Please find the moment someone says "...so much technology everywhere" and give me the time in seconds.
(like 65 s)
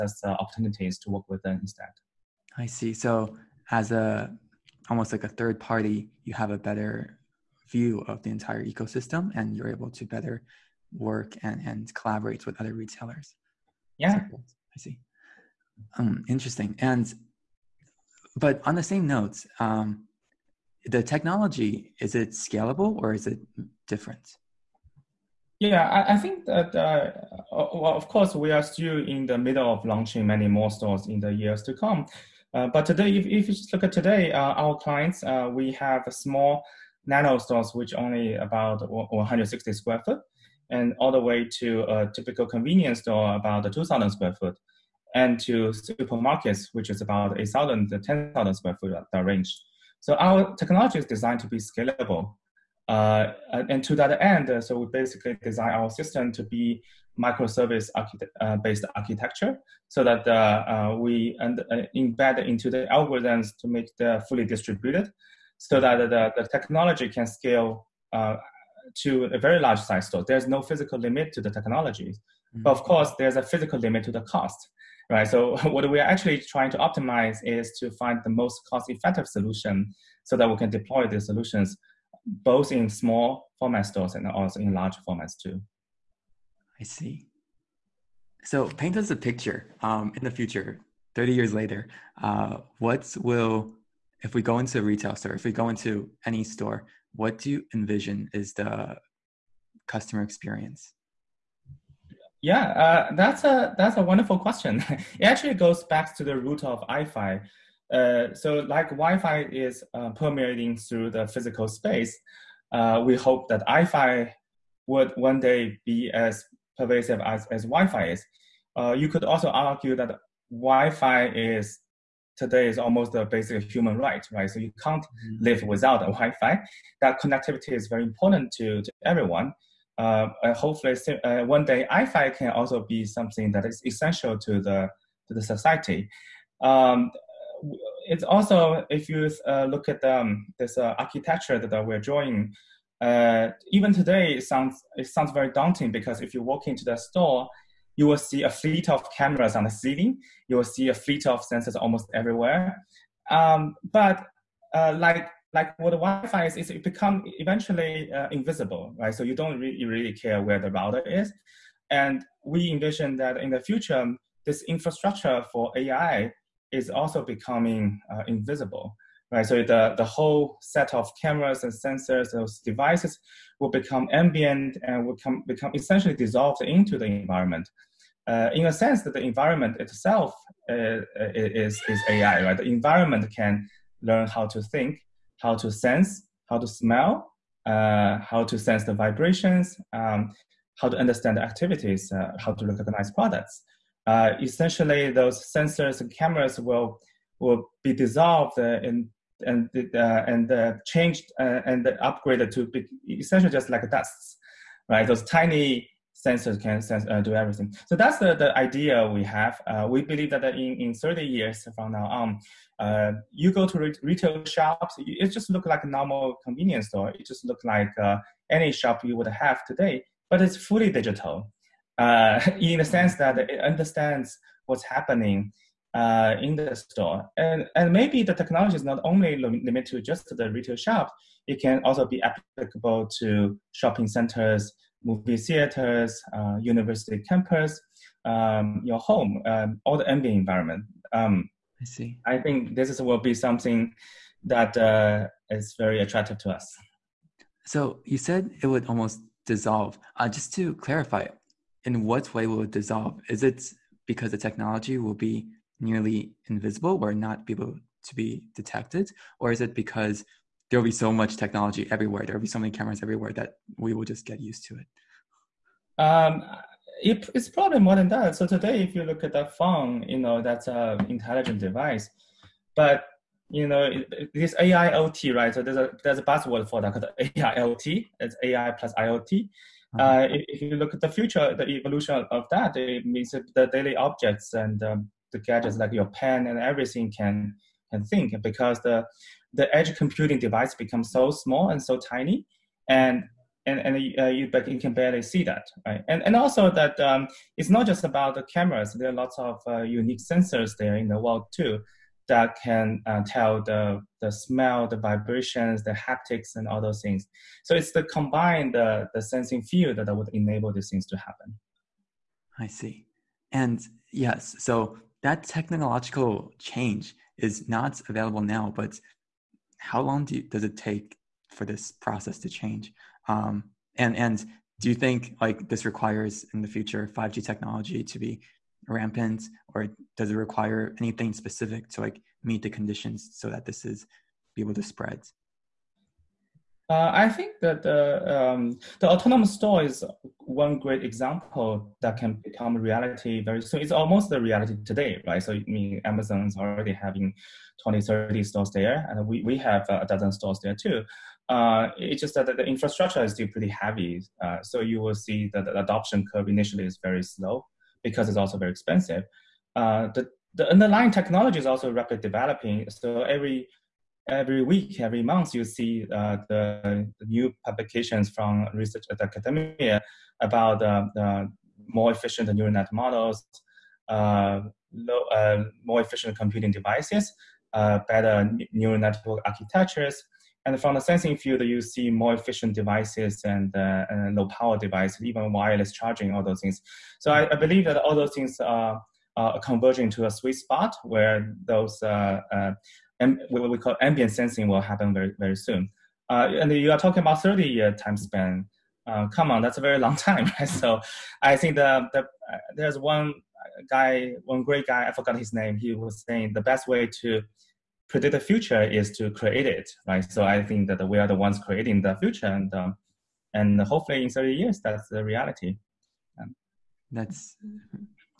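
260 s.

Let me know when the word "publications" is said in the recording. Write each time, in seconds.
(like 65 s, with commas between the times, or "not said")
367 s.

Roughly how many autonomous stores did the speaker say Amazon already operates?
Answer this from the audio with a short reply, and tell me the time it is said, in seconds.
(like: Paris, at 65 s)
20 to 30, at 347 s.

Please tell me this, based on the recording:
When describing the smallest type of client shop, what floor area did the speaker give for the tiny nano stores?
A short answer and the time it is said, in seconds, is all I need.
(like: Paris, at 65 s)
160 square feet, at 38 s.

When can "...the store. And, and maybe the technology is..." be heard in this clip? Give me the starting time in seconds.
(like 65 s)
226 s.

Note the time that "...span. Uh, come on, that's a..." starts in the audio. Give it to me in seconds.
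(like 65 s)
398 s.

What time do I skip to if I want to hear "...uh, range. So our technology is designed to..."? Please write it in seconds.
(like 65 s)
49 s.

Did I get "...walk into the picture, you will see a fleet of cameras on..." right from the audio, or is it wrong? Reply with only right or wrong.
wrong.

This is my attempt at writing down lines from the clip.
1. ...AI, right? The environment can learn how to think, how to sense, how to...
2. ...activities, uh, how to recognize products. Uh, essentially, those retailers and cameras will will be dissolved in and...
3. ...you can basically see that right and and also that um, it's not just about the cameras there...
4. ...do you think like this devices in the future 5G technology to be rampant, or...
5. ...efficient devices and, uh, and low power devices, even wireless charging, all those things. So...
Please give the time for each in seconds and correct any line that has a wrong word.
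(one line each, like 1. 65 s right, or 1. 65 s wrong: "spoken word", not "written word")
1. 182 s right
2. 191 s wrong: "sensors", not "retailers"
3. 294 s wrong: "barely", not "basically"
4. 324 s wrong: "requires", not "devices"
5. 382 s right.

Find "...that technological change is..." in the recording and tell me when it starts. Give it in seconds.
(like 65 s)
315 s.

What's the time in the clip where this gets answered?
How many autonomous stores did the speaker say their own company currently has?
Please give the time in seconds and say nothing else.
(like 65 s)
349 s.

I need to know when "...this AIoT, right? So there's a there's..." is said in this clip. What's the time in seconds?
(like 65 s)
274 s.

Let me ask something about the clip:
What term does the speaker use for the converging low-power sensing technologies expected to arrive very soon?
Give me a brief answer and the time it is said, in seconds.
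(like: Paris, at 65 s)
ambient sensing, at 394 s.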